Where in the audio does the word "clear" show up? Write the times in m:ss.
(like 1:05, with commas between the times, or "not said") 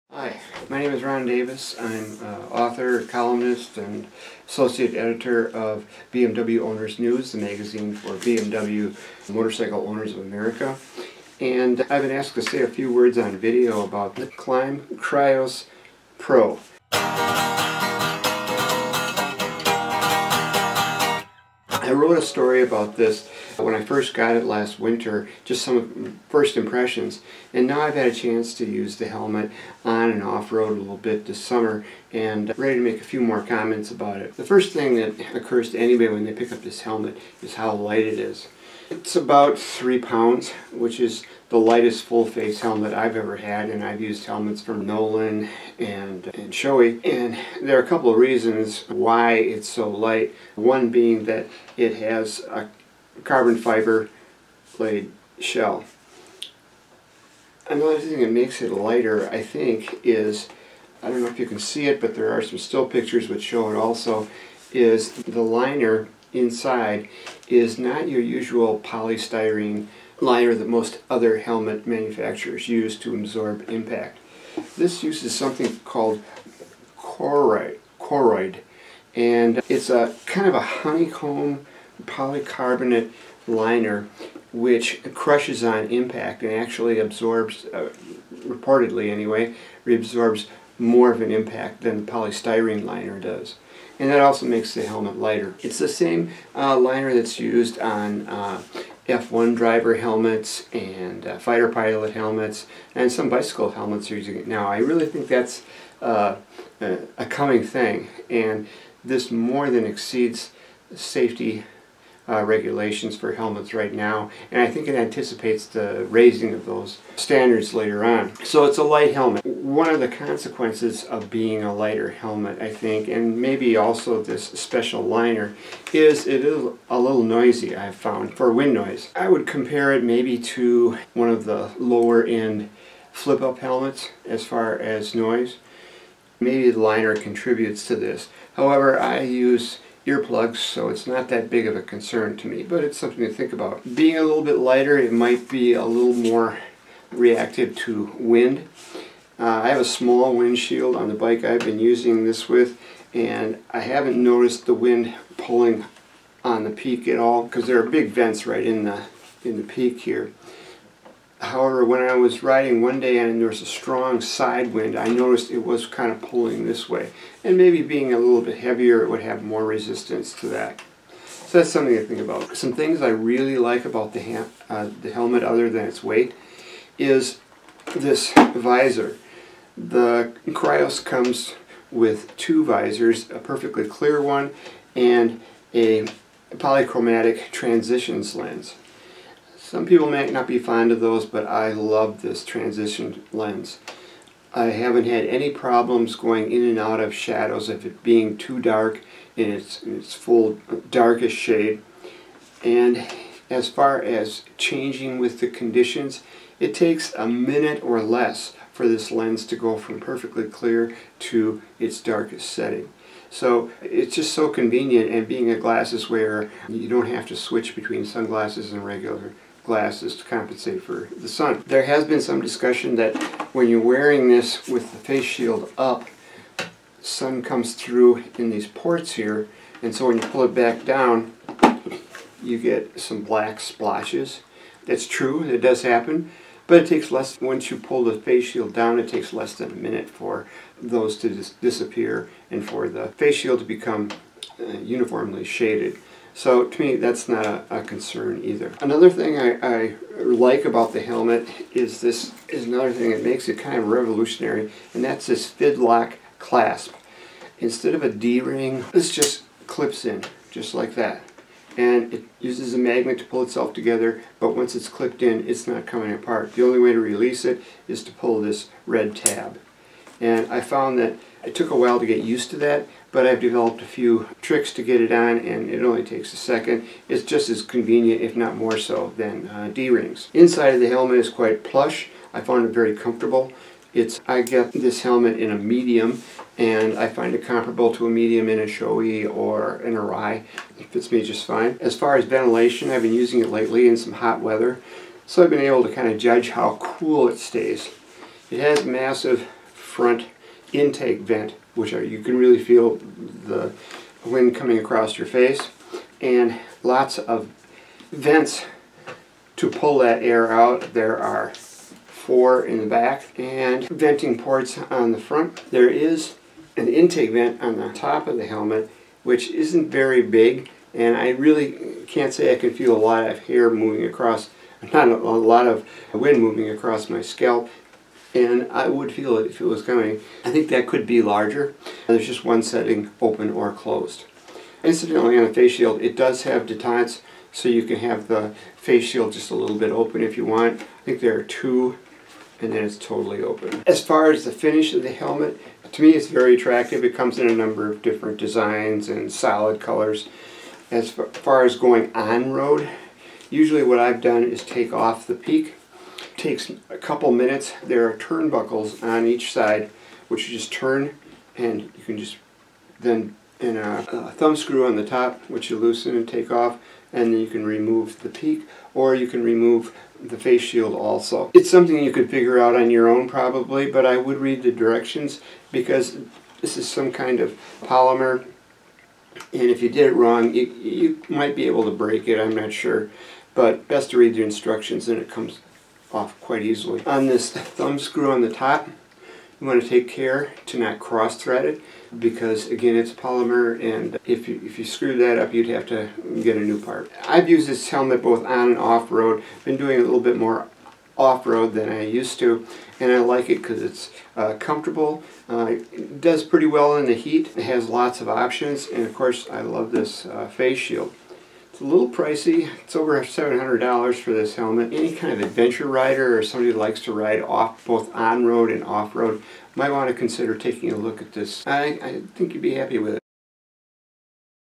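3:03, 3:30.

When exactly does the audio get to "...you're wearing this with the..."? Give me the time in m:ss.
3:43.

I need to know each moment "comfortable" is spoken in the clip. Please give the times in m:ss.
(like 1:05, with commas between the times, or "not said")
4:42, 6:44.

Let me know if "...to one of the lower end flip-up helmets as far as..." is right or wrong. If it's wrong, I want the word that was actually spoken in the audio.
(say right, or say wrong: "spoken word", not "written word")
right.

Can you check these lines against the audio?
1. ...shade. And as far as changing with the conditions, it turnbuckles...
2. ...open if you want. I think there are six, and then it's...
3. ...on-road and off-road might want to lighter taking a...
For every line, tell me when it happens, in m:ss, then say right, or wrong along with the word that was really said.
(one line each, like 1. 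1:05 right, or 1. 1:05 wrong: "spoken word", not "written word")
1. 3:21 wrong: "takes", not "turnbuckles"
2. 5:39 wrong: "two", not "six"
3. 6:58 wrong: "consider", not "lighter".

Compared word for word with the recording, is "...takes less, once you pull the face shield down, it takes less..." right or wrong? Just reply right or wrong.
right.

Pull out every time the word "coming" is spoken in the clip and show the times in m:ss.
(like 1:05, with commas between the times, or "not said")
1:47, 4:25, 5:04, 5:29.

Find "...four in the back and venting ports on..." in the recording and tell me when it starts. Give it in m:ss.
5:11.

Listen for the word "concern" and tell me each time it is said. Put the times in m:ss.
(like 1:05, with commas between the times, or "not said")
2:21, 4:07.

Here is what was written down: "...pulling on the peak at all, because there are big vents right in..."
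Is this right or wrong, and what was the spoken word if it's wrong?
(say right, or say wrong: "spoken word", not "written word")
right.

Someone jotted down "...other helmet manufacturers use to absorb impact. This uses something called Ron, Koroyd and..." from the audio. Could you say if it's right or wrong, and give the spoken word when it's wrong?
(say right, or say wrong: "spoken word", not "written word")
wrong: "Koroyd", not "Ron".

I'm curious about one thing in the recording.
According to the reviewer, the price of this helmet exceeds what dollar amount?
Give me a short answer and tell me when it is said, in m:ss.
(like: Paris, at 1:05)
$700, at 6:53.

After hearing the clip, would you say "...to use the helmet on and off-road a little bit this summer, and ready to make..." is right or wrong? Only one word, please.
right.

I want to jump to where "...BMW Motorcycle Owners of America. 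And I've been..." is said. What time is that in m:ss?
0:08.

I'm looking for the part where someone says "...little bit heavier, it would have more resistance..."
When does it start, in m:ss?
2:48.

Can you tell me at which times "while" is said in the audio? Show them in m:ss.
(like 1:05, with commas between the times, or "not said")
4:31.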